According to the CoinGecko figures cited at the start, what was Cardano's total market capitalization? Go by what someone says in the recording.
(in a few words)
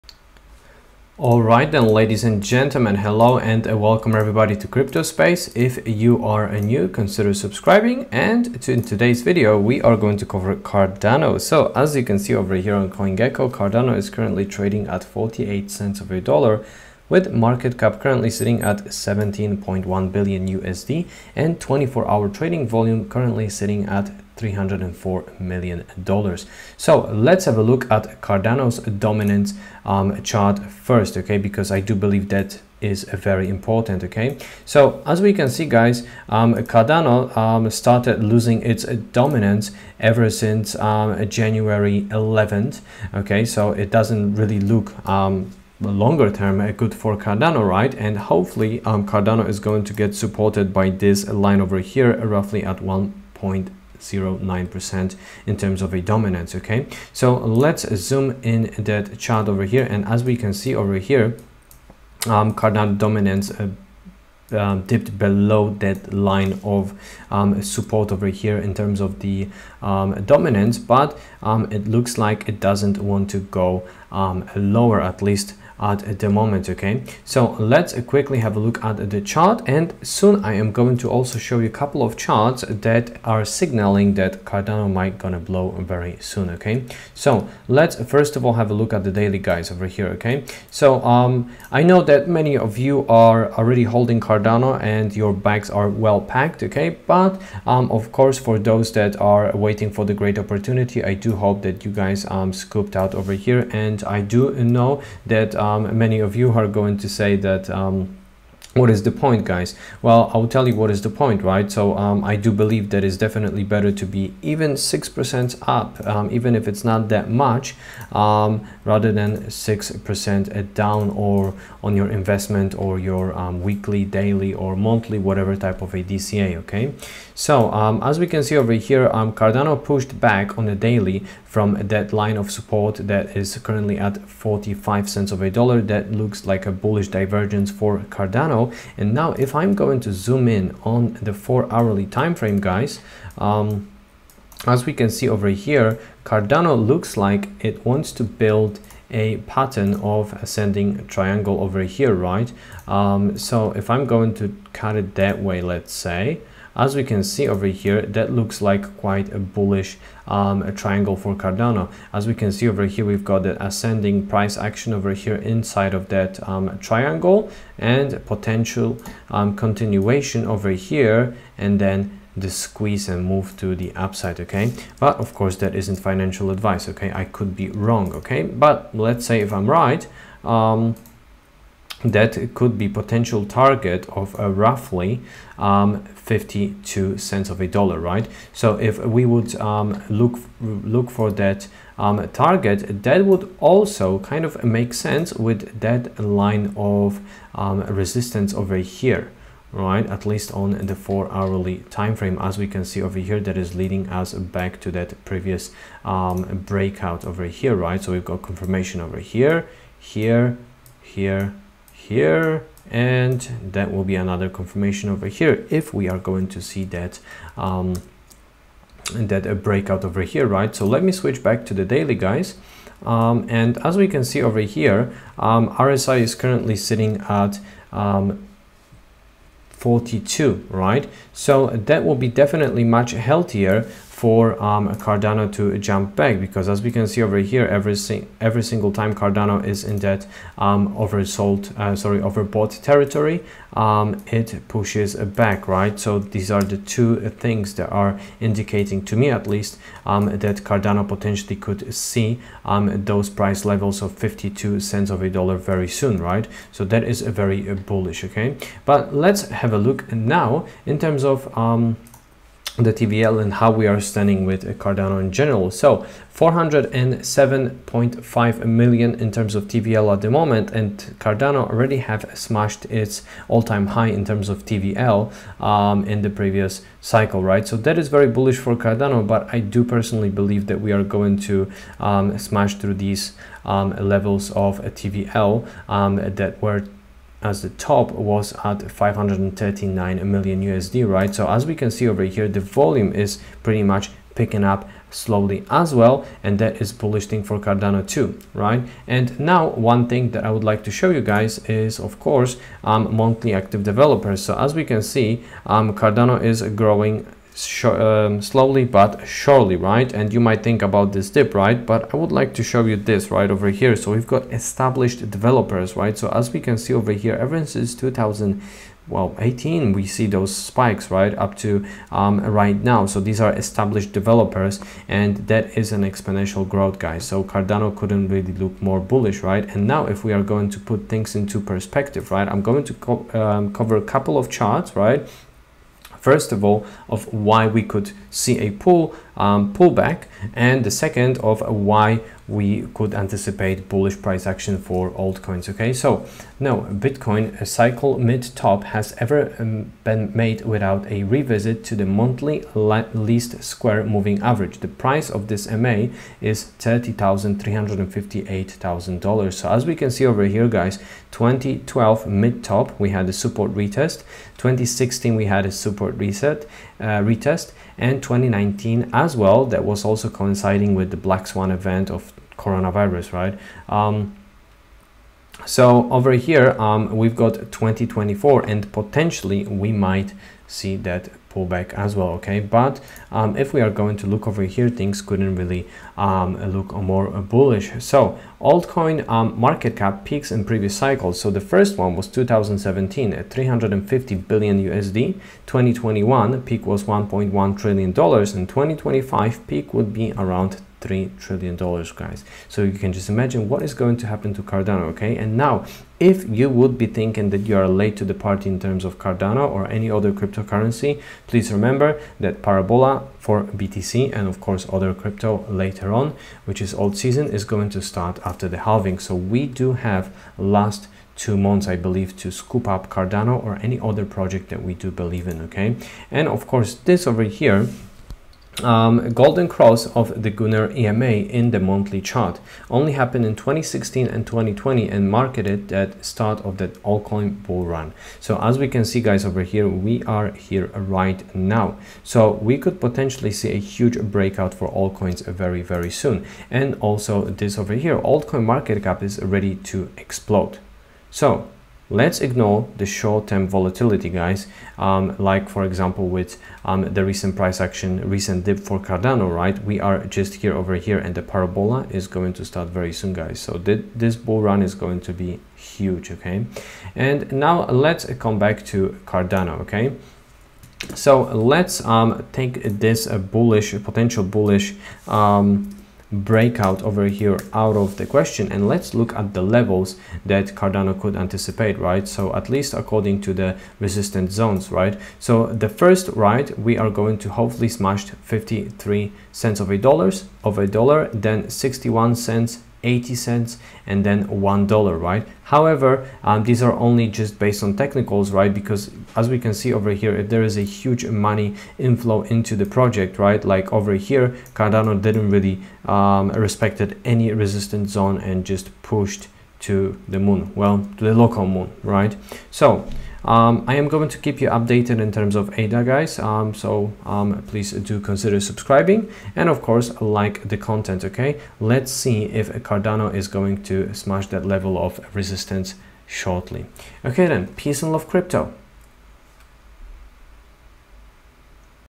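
17.1 billion USD.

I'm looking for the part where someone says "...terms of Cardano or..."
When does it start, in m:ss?
6:48.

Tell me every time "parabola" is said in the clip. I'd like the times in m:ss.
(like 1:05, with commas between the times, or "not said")
6:52, 7:41.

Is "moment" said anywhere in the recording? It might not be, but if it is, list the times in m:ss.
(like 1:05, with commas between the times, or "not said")
1:16, 4:30.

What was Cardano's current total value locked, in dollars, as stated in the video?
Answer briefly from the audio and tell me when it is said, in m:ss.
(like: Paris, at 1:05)
407.5 million, at 4:26.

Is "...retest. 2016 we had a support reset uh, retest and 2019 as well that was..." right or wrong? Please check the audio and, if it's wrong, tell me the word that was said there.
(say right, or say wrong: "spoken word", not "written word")
right.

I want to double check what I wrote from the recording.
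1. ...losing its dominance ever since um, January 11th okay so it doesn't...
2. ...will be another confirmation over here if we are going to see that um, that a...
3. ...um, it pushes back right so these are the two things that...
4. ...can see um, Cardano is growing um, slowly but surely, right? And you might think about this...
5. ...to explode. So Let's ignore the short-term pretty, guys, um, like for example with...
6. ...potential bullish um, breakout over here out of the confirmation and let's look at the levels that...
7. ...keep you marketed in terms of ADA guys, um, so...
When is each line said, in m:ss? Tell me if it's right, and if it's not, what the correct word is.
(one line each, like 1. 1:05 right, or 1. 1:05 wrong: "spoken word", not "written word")
1. 0:38 right
2. 3:33 right
3. 4:03 right
4. 5:04 right
5. 7:29 wrong: "volatility", not "pretty"
6. 7:54 wrong: "question", not "confirmation"
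7. 8:34 wrong: "updated", not "marketed".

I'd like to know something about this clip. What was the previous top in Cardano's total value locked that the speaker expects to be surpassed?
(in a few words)
539 million USD.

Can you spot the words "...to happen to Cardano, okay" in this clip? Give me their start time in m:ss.
6:44.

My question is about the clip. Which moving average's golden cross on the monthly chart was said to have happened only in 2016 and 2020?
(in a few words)
Gunnar EMA.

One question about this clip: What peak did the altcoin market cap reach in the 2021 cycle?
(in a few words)
1.1 trillion dollars.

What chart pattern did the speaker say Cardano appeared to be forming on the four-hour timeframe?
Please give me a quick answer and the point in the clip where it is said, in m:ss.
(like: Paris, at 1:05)
Ascending triangle, at 2:30.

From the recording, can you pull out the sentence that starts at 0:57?
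So let's zoom in that chart over here.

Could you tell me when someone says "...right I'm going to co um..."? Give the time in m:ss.
5:32.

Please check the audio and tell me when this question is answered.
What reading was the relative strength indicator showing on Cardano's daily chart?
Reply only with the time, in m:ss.
3:49.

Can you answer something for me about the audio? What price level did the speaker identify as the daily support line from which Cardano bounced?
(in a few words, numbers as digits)
45 cents.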